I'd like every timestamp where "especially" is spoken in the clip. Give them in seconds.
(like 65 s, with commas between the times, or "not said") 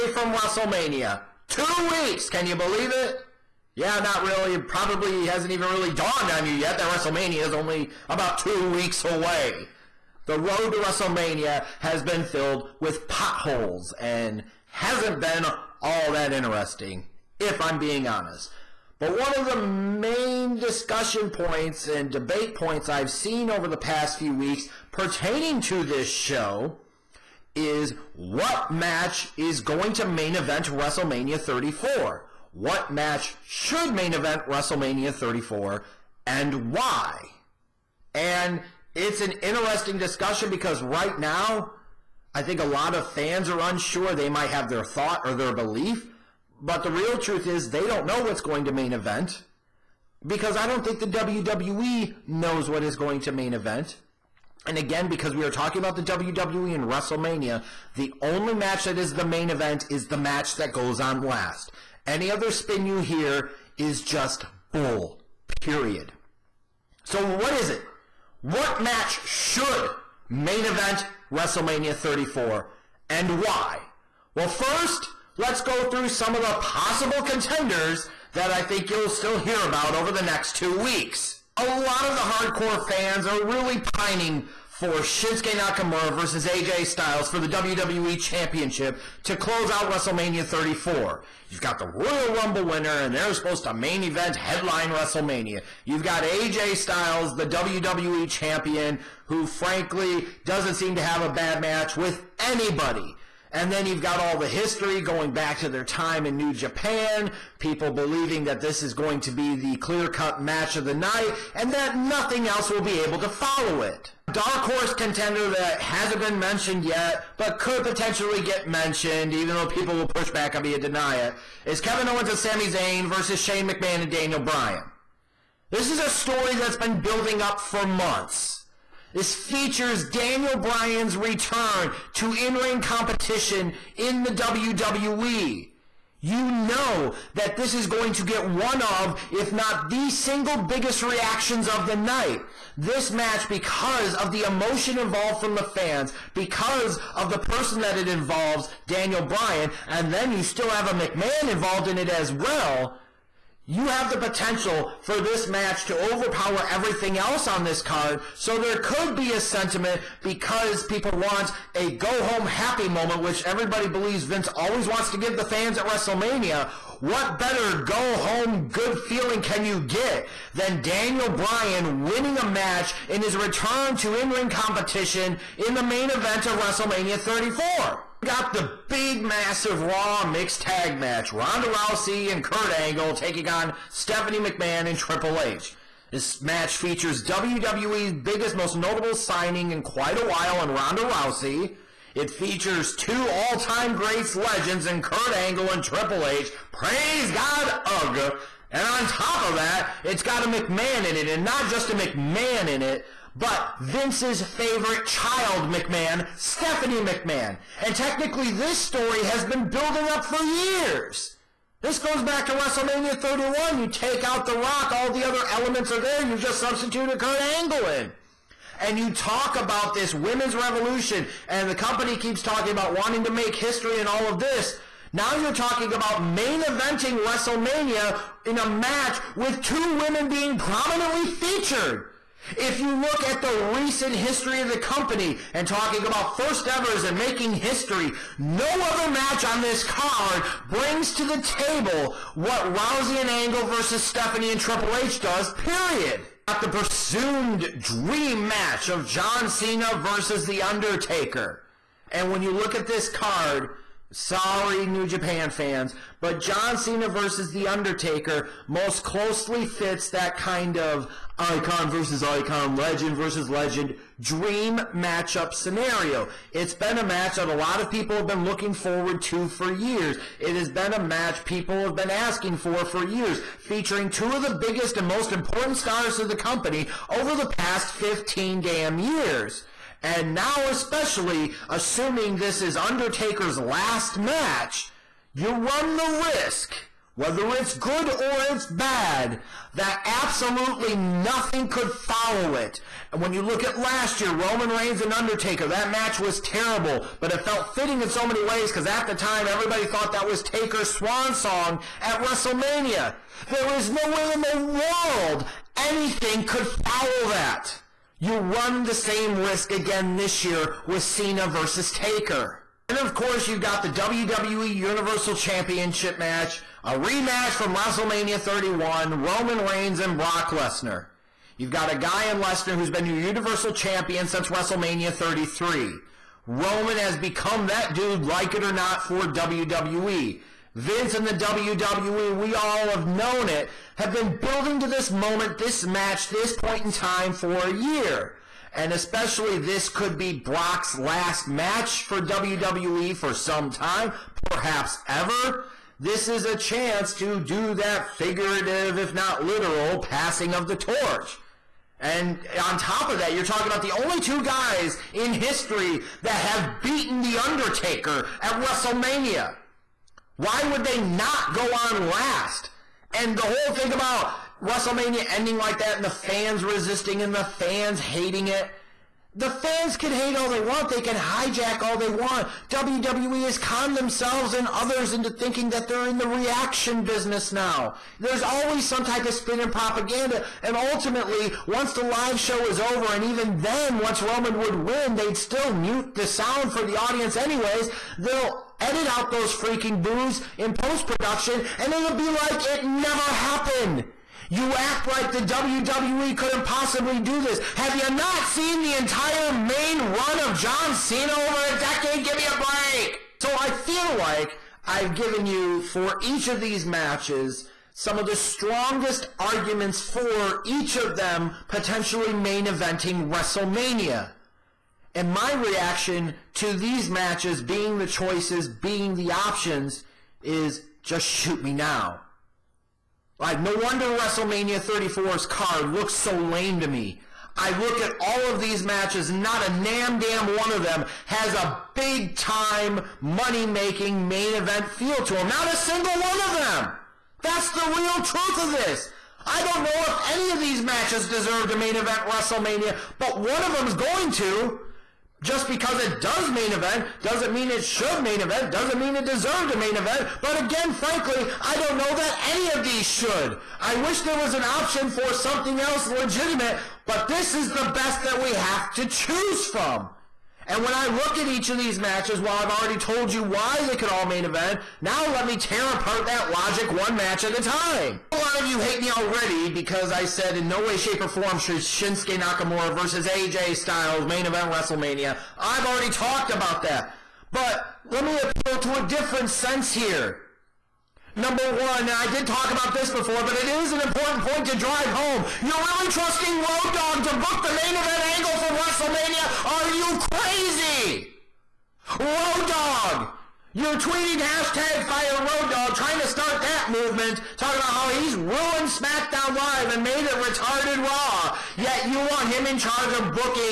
280 s, 338 s.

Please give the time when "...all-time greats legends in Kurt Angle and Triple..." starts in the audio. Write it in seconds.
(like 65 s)
193 s.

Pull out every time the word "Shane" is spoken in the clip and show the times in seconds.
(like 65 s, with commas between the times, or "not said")
123 s.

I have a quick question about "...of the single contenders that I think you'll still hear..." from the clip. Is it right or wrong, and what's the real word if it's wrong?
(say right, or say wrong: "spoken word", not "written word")
wrong: "possible", not "single".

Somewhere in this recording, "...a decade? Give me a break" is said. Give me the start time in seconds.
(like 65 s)
401 s.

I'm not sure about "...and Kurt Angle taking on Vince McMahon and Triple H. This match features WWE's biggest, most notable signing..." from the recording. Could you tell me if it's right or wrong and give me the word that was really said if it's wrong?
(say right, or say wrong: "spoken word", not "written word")
wrong: "Stephanie", not "Vince".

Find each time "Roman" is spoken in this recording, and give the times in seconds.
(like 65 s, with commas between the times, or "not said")
294 s, 319 s, 326 s, 384 s.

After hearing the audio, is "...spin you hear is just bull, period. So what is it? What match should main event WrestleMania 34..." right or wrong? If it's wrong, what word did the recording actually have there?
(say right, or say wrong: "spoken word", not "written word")
right.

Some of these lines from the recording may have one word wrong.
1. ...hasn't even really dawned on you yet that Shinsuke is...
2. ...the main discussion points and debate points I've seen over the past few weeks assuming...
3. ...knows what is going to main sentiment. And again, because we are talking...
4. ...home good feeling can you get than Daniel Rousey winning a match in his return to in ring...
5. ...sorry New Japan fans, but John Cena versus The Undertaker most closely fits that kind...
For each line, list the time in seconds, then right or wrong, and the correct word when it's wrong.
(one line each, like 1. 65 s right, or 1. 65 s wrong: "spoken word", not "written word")
1. 5 s wrong: "WrestleMania", not "Shinsuke"
2. 19 s wrong: "pertaining", not "assuming"
3. 52 s wrong: "event", not "sentiment"
4. 168 s wrong: "Bryan", not "Rousey"
5. 254 s right.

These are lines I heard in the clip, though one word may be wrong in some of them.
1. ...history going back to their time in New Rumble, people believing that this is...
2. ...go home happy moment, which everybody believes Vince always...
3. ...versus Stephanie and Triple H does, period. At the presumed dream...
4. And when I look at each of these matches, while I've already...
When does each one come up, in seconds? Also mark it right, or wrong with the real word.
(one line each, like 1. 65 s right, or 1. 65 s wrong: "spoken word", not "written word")
1. 104 s wrong: "Japan", not "Rumble"
2. 161 s right
3. 243 s right
4. 460 s right.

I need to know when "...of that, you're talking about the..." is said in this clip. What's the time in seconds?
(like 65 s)
353 s.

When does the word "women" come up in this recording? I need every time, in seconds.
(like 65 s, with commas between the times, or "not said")
220 s, 229 s.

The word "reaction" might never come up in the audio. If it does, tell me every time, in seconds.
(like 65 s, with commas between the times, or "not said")
141 s, 376 s, 415 s.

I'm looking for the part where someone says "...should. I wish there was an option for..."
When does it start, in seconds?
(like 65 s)
453 s.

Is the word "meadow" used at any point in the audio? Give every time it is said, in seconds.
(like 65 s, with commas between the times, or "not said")
not said.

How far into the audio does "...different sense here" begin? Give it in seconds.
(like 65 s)
479 s.